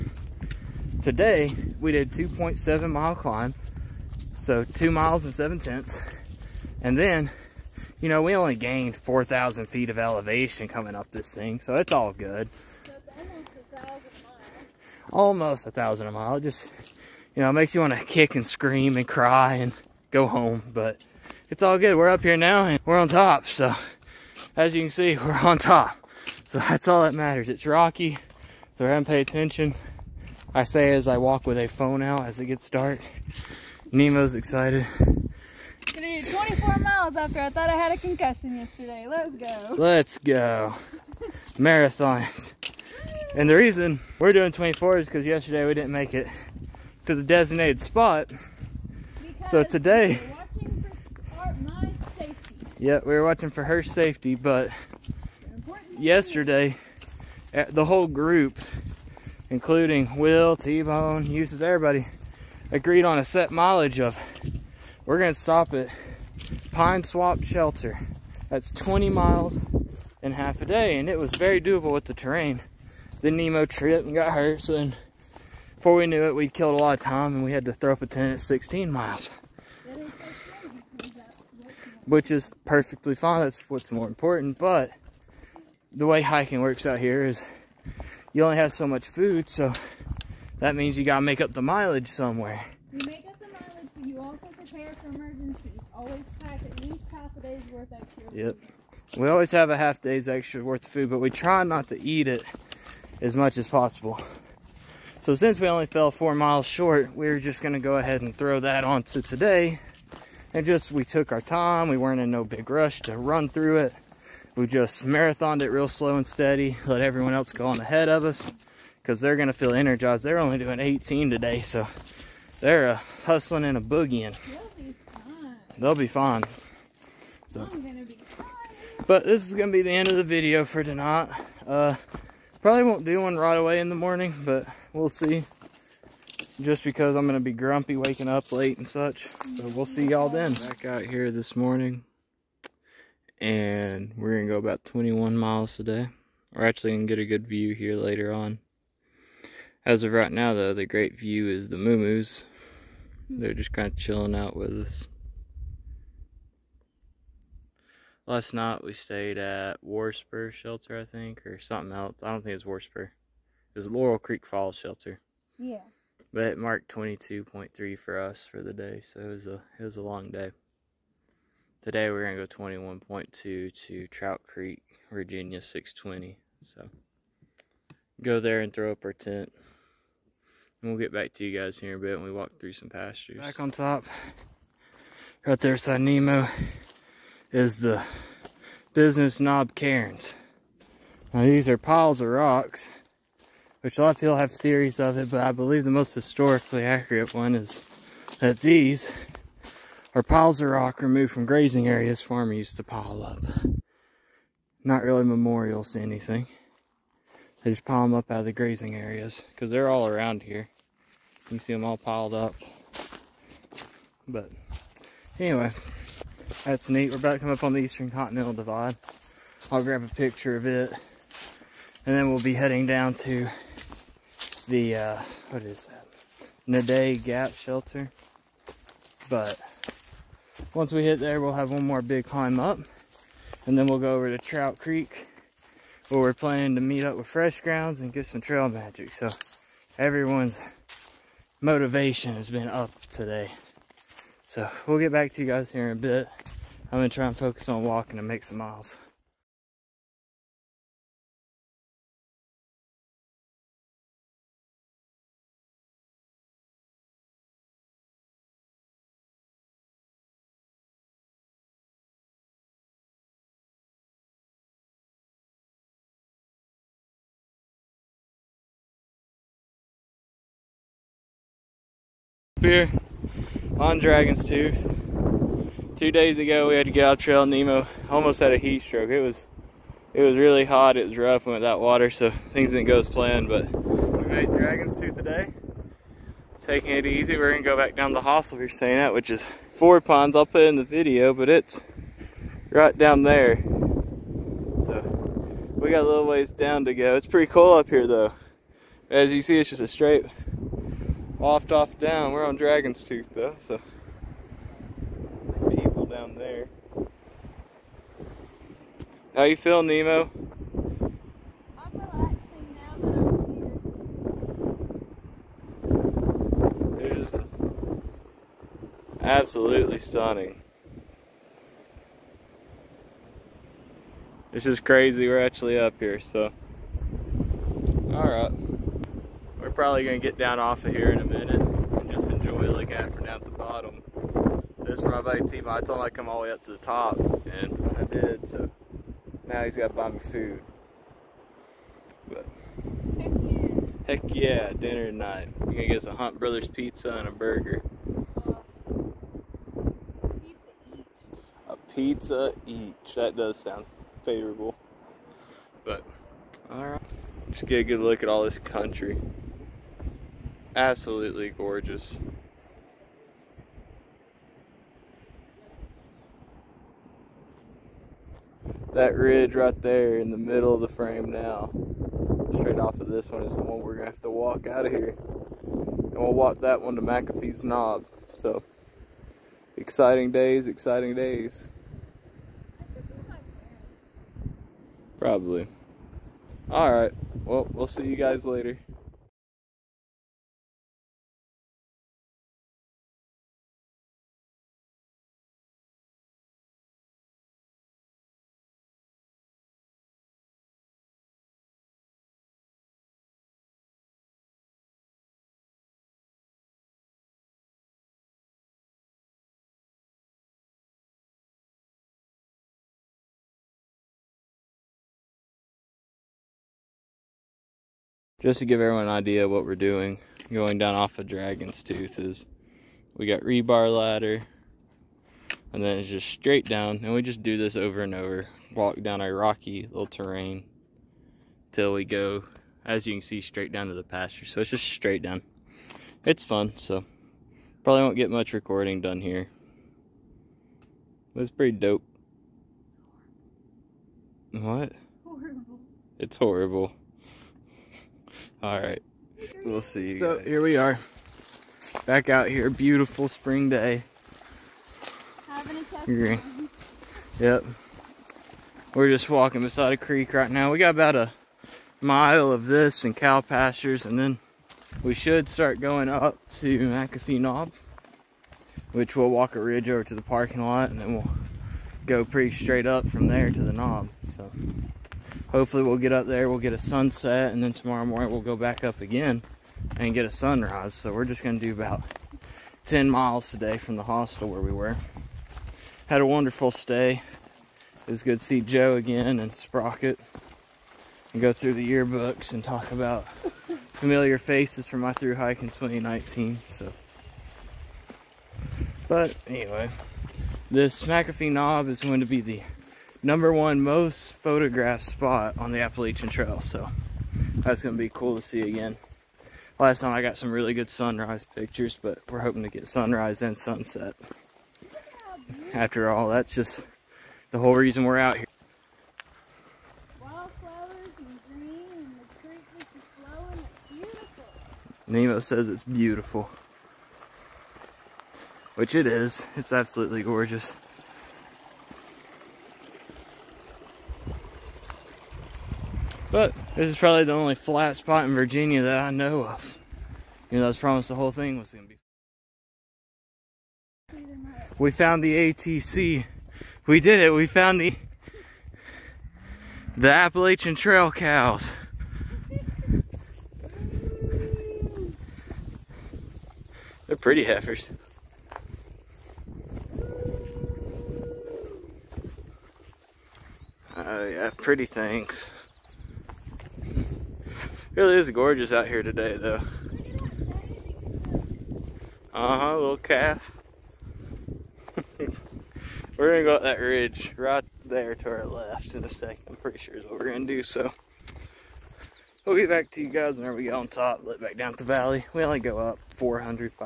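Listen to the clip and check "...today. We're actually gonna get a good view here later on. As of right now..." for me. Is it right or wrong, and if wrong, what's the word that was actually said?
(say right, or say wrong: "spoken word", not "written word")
right.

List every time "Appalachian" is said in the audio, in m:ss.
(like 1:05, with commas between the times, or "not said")
8:25, 9:10.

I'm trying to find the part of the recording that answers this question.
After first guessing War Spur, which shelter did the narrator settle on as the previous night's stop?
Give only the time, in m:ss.
2:43.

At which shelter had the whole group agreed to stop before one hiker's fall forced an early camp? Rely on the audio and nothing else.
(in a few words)
Pine Swamp Shelter.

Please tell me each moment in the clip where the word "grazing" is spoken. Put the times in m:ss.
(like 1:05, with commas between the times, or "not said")
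3:21, 3:28.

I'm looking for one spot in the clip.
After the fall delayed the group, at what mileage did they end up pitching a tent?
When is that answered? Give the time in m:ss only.
1:18.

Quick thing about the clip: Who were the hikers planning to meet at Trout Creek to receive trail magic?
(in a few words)
Fresh Grounds.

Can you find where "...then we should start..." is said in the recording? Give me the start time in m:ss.
7:44.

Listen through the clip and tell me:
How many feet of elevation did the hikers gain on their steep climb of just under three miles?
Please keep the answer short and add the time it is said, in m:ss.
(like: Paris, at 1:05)
4,000, at 0:08.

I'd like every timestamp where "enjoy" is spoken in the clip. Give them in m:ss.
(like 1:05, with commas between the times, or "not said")
5:32.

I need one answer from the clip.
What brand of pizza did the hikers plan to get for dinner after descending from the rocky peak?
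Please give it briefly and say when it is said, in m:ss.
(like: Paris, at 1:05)
Hunt Brothers, at 5:46.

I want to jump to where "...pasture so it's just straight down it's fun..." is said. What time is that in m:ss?
7:14.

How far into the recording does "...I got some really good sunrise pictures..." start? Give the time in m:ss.
8:30.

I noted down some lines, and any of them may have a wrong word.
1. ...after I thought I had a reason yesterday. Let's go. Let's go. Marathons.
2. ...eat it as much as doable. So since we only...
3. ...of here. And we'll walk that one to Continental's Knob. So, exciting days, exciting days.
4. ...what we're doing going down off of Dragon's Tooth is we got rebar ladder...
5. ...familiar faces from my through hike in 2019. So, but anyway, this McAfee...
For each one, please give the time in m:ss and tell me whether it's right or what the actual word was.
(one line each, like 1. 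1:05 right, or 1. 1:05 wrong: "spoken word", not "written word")
1. 0:37 wrong: "concussion", not "reason"
2. 1:42 wrong: "possible", not "doable"
3. 6:14 wrong: "McAfee", not "Continental"
4. 6:59 right
5. 8:13 right.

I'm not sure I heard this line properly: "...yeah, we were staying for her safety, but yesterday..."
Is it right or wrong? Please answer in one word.
wrong.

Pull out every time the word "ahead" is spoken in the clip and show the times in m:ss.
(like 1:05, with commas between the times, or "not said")
1:47, 1:57.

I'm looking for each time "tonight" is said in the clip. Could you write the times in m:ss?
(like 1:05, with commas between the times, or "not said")
2:10, 5:45.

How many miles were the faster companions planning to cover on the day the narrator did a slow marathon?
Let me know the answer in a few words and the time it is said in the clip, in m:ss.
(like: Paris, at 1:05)
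18, at 2:00.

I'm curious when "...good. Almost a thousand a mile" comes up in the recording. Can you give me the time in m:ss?
0:12.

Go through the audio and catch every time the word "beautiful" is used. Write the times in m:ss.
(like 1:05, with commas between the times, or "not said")
7:32, 8:45.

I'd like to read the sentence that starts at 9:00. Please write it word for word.
You know, I was promised the whole thing was going to be.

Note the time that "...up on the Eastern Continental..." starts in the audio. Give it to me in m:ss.
3:37.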